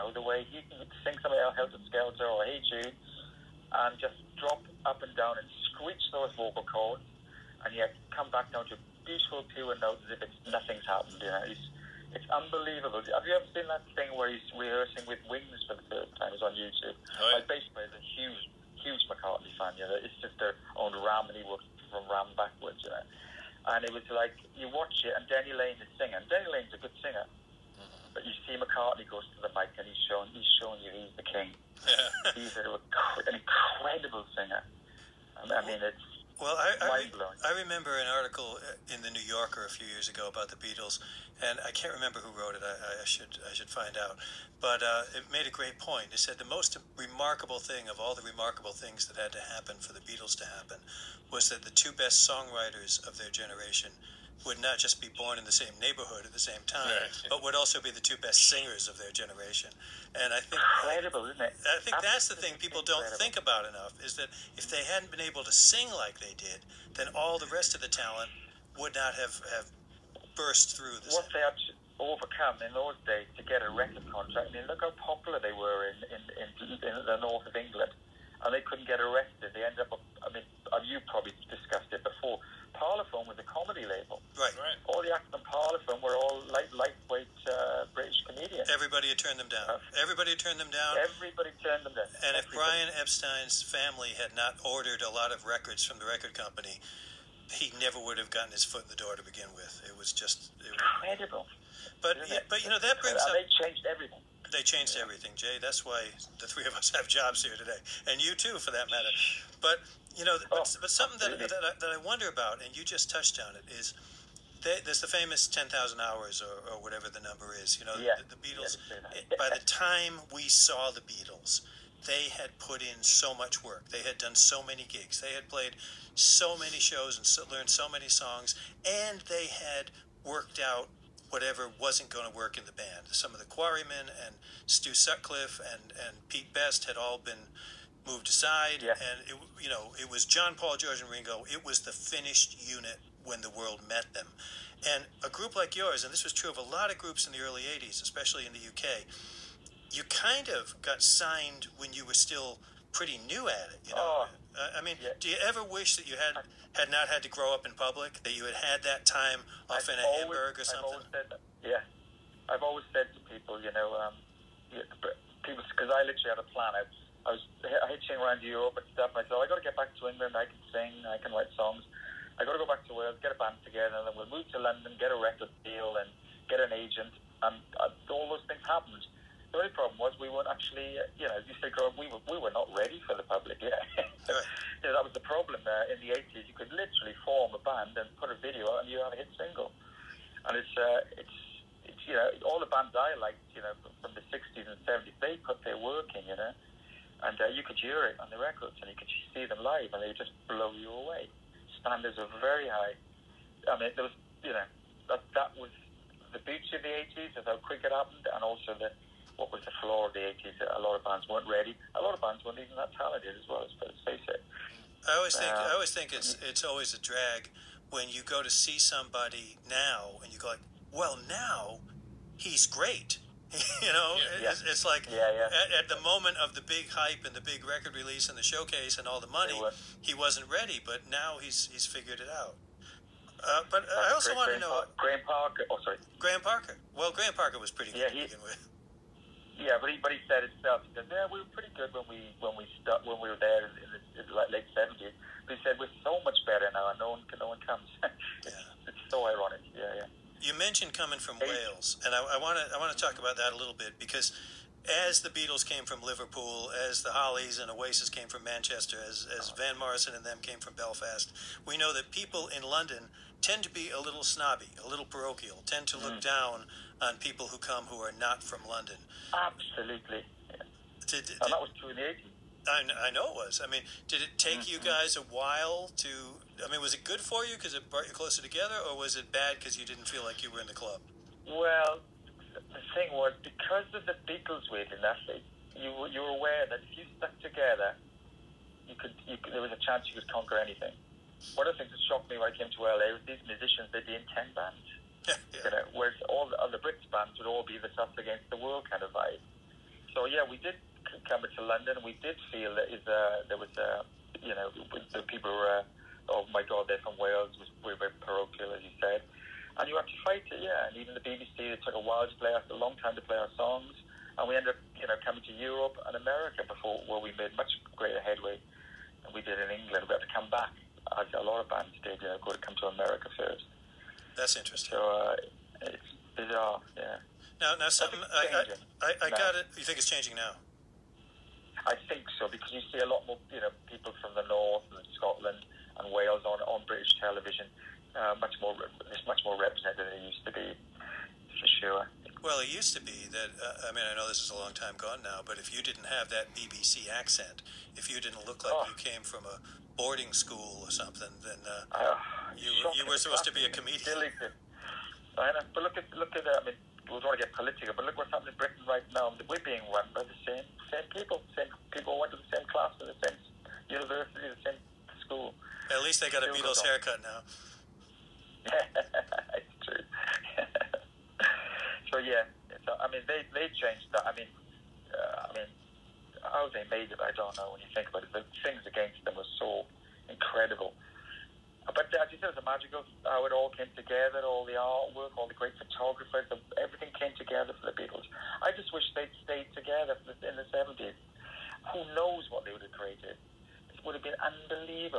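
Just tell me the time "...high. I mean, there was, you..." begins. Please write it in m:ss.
3:22.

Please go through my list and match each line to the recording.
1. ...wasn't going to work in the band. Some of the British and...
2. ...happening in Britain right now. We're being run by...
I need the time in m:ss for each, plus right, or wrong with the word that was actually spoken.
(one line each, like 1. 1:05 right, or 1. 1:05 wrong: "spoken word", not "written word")
1. 2:11 wrong: "Quarrymen", not "British"
2. 5:58 right.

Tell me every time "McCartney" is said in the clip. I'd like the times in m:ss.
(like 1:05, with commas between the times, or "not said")
0:19, 0:28.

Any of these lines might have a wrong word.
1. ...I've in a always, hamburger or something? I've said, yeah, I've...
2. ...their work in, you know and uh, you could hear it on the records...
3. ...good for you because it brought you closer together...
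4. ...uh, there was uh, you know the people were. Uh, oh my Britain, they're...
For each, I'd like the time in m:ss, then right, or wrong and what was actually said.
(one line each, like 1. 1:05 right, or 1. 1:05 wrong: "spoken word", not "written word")
1. 2:39 right
2. 3:15 right
3. 4:37 right
4. 5:03 wrong: "God", not "Britain".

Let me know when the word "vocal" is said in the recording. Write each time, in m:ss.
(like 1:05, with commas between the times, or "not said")
0:06.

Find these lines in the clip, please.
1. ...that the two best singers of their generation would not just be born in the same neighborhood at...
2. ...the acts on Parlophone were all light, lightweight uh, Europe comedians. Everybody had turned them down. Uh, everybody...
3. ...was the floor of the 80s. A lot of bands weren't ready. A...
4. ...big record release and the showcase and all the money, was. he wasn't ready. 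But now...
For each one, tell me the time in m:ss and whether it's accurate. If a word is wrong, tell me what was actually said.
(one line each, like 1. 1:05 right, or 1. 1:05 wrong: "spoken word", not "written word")
1. 0:51 wrong: "songwriters", not "singers"
2. 1:25 wrong: "British", not "Europe"
3. 3:29 right
4. 3:47 right.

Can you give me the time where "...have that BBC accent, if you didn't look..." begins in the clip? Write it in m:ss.
5:46.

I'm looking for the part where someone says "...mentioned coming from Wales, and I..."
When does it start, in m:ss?
4:10.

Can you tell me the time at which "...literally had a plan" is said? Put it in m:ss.
2:46.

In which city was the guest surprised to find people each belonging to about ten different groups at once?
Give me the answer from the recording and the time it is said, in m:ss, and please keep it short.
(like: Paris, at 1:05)
LA, at 4:52.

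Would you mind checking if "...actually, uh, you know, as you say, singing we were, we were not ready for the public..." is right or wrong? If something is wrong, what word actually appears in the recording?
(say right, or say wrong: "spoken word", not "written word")
wrong: "growing", not "singing".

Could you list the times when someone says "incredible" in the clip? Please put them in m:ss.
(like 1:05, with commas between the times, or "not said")
0:33, 1:00, 1:41, 6:20.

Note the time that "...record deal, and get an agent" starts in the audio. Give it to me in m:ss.
2:55.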